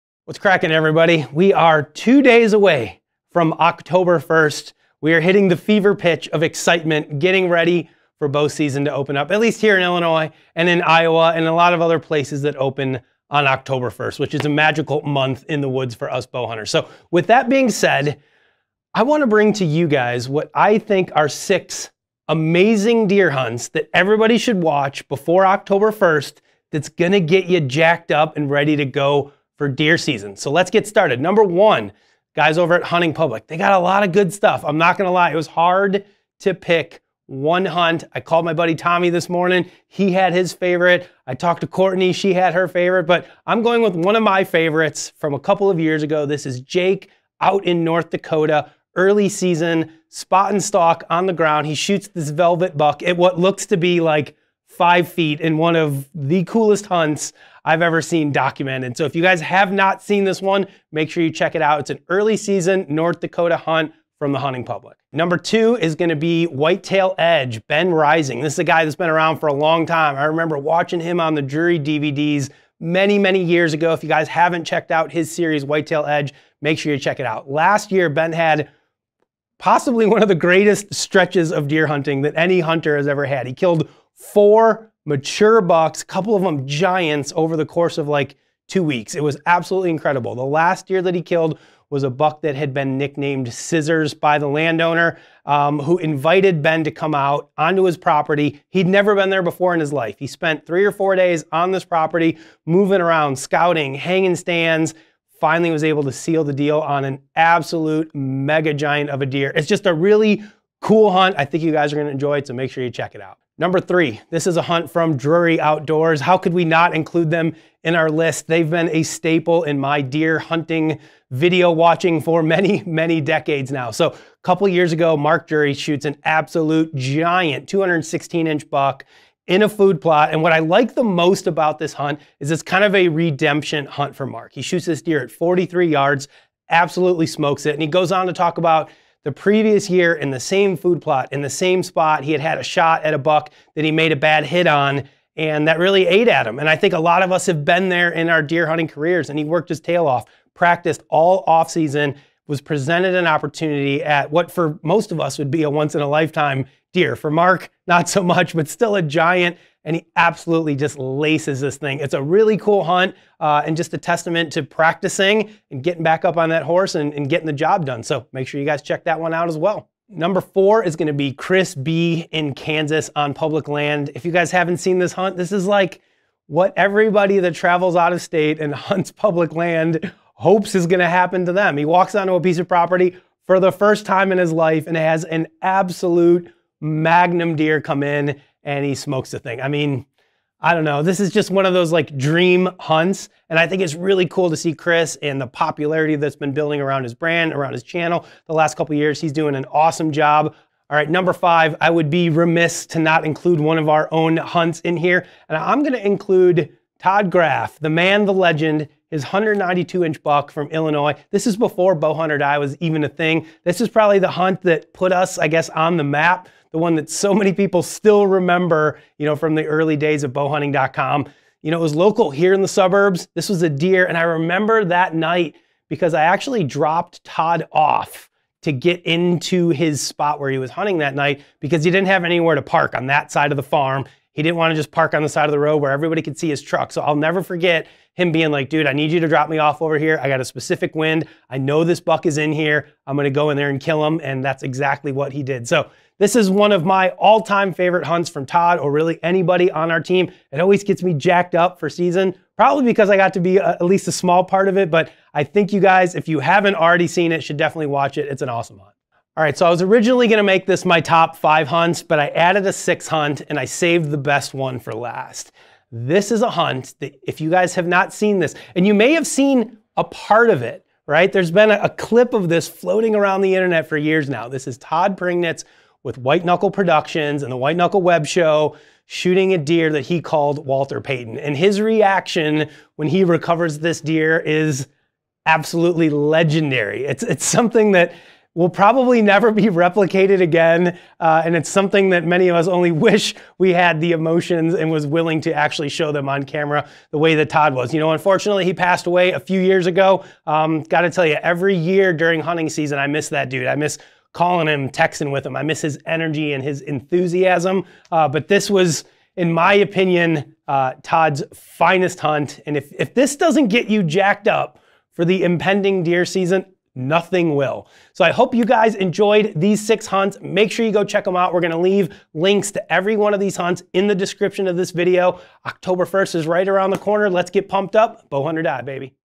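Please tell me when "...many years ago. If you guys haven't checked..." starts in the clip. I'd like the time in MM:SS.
01:13.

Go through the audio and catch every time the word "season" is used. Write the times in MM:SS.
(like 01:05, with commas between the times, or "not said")
00:08, 00:29, 00:49, 01:02, 02:31, 04:11, 05:02, 05:16.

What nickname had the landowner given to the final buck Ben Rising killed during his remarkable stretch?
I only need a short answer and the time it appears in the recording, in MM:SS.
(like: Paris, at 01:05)
Scissors, at 01:33.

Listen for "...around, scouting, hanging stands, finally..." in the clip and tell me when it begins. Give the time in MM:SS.
01:43.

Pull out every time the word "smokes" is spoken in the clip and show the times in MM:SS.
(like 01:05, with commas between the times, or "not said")
02:17, 03:08.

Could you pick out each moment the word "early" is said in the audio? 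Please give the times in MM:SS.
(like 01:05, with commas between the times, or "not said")
00:48, 01:02, 03:39.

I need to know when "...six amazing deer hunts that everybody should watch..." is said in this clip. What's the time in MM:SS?
00:21.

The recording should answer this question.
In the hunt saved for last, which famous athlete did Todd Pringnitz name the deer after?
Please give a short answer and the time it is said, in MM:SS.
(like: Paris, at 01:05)
Walter Payton, at 04:40.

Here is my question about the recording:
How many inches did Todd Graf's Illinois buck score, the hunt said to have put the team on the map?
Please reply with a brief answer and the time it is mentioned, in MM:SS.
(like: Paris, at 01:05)
192 inches, at 03:29.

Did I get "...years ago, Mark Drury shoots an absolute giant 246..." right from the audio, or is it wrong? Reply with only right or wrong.
wrong.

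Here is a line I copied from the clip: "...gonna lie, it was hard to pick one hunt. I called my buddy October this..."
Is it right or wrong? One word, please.
wrong.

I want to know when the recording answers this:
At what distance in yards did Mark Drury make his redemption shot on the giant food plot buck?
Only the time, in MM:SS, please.
02:15.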